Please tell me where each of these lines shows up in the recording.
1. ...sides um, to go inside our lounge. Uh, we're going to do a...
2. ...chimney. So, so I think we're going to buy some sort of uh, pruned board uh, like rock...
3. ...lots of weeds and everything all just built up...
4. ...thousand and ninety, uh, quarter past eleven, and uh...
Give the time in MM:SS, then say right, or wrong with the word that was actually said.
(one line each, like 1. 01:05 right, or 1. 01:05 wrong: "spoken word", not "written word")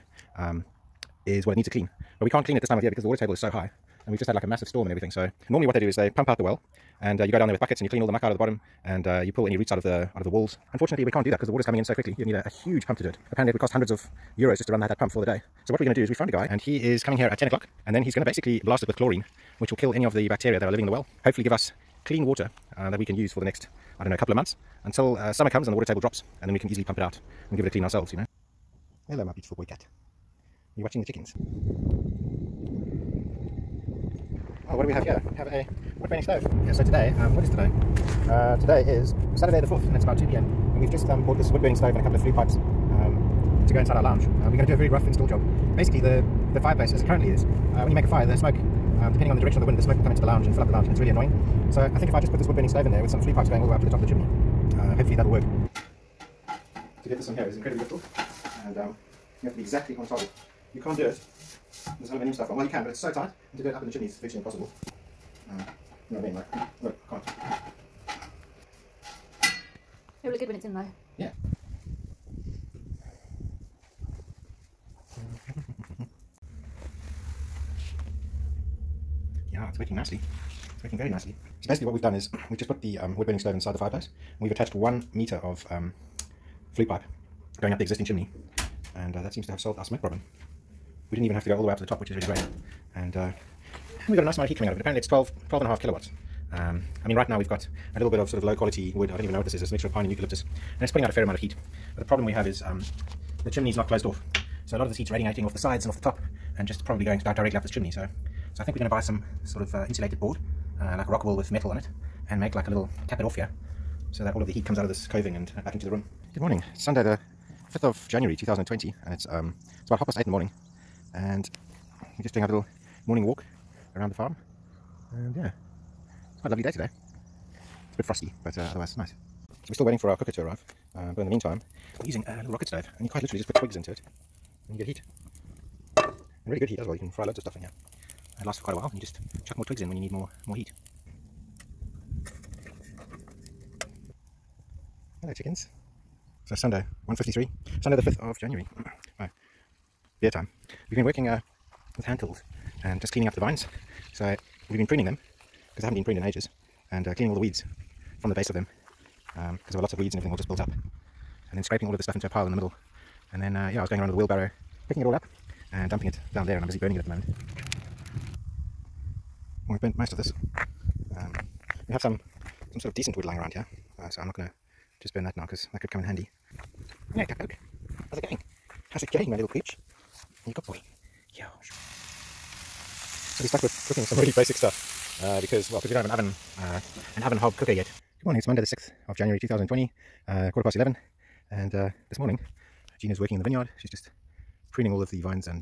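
1. 00:42 wrong: "pipes", not "sides"
2. 01:47 wrong: "insulated", not "pruned"
3. 02:39 right
4. 03:09 wrong: "twenty", not "ninety".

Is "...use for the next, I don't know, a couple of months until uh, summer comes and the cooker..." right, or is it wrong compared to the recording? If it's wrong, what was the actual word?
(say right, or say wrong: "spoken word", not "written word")
wrong: "water", not "cooker".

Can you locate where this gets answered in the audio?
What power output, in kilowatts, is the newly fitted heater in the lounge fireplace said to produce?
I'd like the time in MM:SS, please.
01:35.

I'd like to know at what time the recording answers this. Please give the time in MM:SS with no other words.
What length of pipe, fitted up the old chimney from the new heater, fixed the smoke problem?
01:24.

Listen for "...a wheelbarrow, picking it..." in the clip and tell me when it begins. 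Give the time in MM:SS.
02:44.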